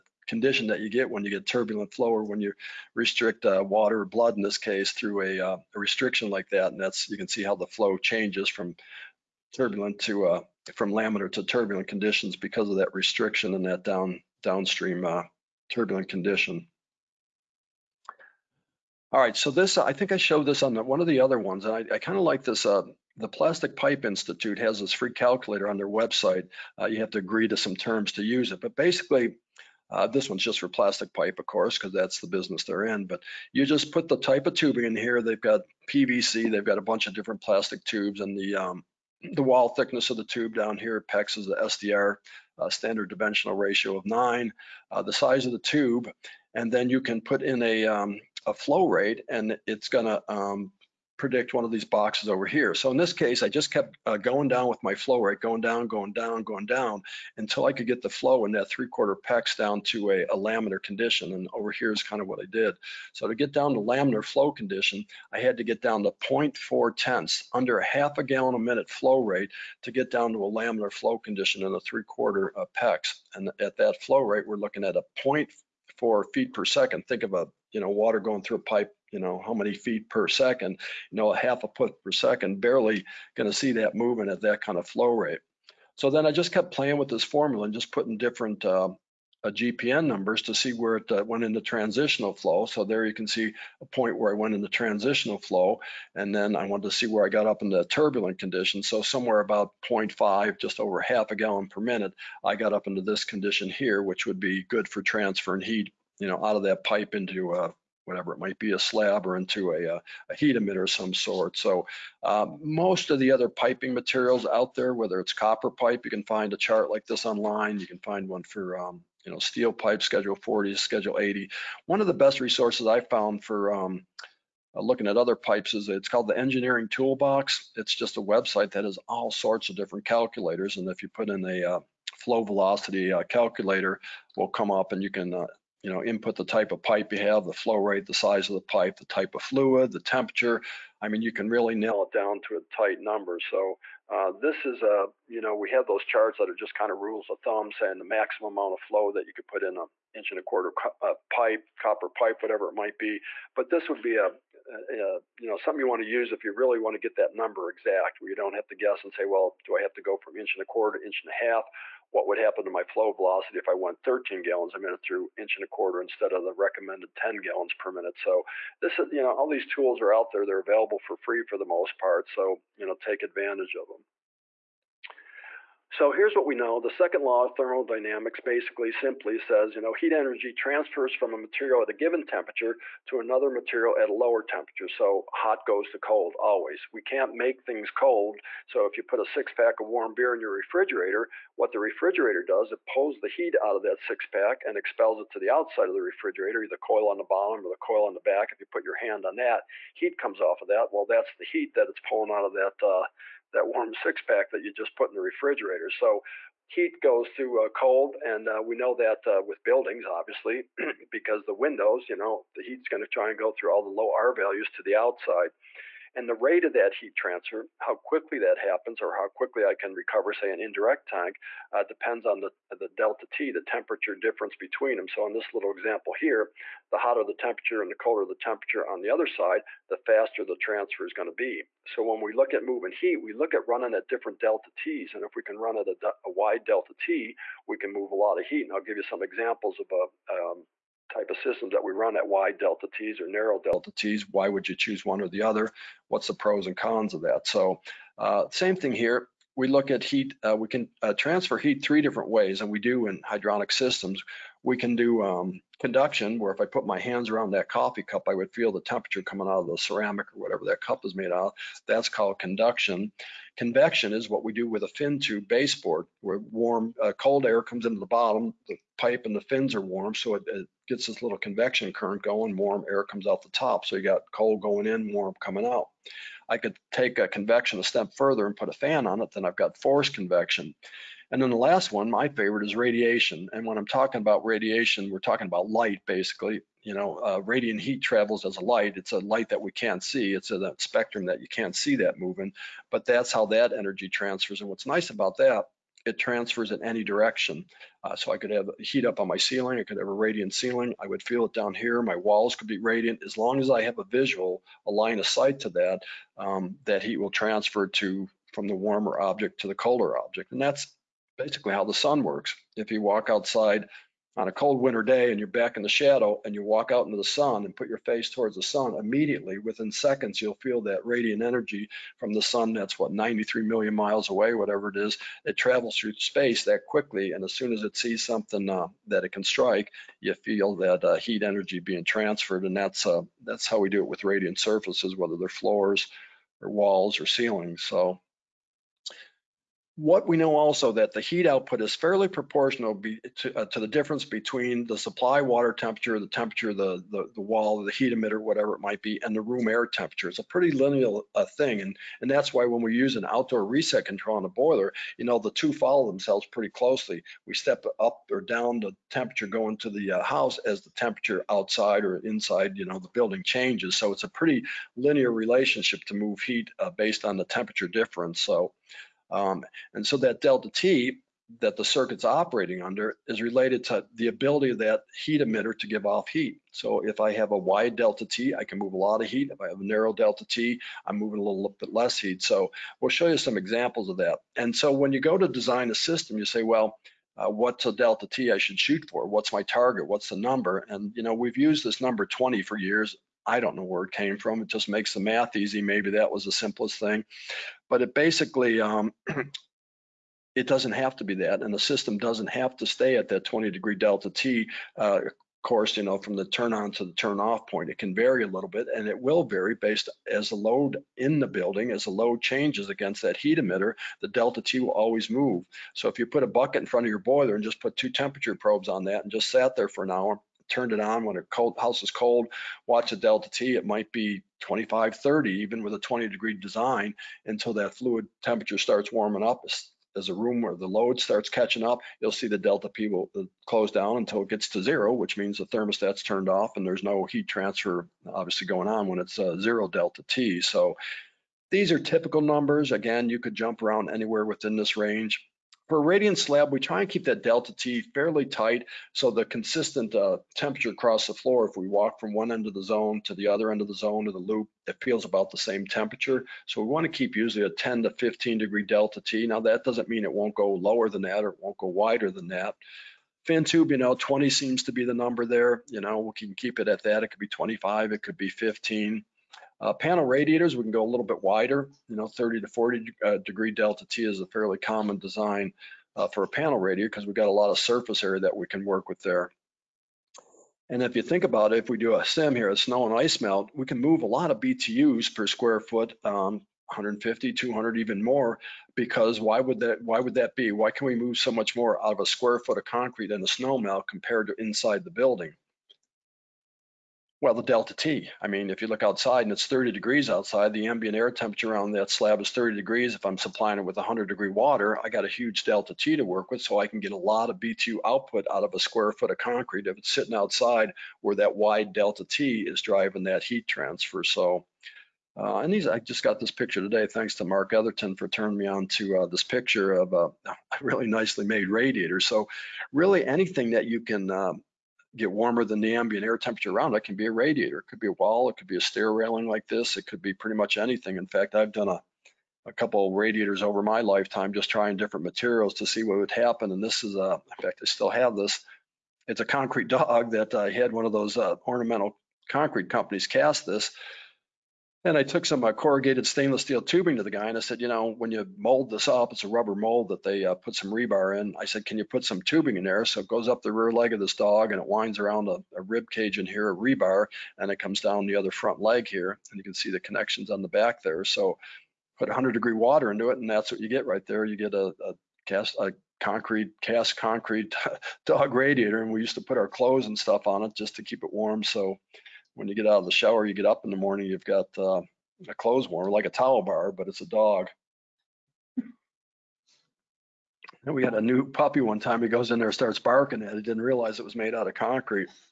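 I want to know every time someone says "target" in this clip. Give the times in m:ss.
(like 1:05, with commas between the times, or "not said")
6:29.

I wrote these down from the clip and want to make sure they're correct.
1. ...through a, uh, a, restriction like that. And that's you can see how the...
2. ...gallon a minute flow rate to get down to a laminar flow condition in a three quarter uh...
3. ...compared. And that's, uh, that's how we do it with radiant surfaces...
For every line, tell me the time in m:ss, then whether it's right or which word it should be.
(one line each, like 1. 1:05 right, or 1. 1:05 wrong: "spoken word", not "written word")
1. 0:04 right
2. 1:08 right
3. 5:32 wrong: "transferred", not "compared".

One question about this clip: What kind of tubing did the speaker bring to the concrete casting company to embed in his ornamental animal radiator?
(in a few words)
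Corrugated stainless steel.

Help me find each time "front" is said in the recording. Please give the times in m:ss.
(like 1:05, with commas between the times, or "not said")
6:56, 9:18.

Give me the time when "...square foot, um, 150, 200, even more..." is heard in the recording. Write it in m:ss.
8:05.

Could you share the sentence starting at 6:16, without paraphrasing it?
So if I have a wide delta T, I can move a lot of heat.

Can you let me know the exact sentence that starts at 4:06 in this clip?
What's the pros and cons of that?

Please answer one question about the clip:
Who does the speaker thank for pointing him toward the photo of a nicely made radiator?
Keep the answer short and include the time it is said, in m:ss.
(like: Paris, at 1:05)
Mark Etherton, at 8:37.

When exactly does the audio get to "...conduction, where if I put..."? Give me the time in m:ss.
4:15.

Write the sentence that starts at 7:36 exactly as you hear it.
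So we want to keep usually a 10 to 15 degree delta T.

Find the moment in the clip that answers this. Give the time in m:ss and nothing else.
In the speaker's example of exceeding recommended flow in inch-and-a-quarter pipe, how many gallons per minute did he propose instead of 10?
2:44.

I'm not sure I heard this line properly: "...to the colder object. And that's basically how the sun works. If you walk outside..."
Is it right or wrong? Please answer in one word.
right.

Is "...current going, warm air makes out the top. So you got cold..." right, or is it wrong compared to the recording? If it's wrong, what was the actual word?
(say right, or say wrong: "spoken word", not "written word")
wrong: "comes", not "makes".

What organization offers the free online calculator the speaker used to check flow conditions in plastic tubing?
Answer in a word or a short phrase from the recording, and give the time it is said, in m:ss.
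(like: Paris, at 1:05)
Plastic Pipe Institute, at 0:23.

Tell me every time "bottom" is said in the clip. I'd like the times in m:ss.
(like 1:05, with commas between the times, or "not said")
3:17, 4:28.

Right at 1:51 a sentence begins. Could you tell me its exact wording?
So uh, most of the other piping materials out there, whether it's copper pipe, you can find a chart like this online.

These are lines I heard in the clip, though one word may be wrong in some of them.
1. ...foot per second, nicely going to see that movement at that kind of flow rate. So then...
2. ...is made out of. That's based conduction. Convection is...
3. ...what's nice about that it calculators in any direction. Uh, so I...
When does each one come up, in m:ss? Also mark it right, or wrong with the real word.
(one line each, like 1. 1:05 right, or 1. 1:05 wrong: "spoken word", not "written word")
1. 1:21 wrong: "barely", not "nicely"
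2. 4:21 wrong: "called", not "based"
3. 4:54 wrong: "transfers", not "calculators".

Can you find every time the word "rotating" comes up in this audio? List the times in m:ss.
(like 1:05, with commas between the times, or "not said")
not said.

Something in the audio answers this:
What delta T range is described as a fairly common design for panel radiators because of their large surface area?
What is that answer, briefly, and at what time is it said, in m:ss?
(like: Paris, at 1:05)
30 to 40, at 7:52.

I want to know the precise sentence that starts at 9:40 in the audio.
And we had a new puppy one time.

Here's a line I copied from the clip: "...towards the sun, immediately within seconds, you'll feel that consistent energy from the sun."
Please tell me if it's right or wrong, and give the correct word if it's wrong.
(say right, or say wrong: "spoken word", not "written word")
wrong: "radiant", not "consistent".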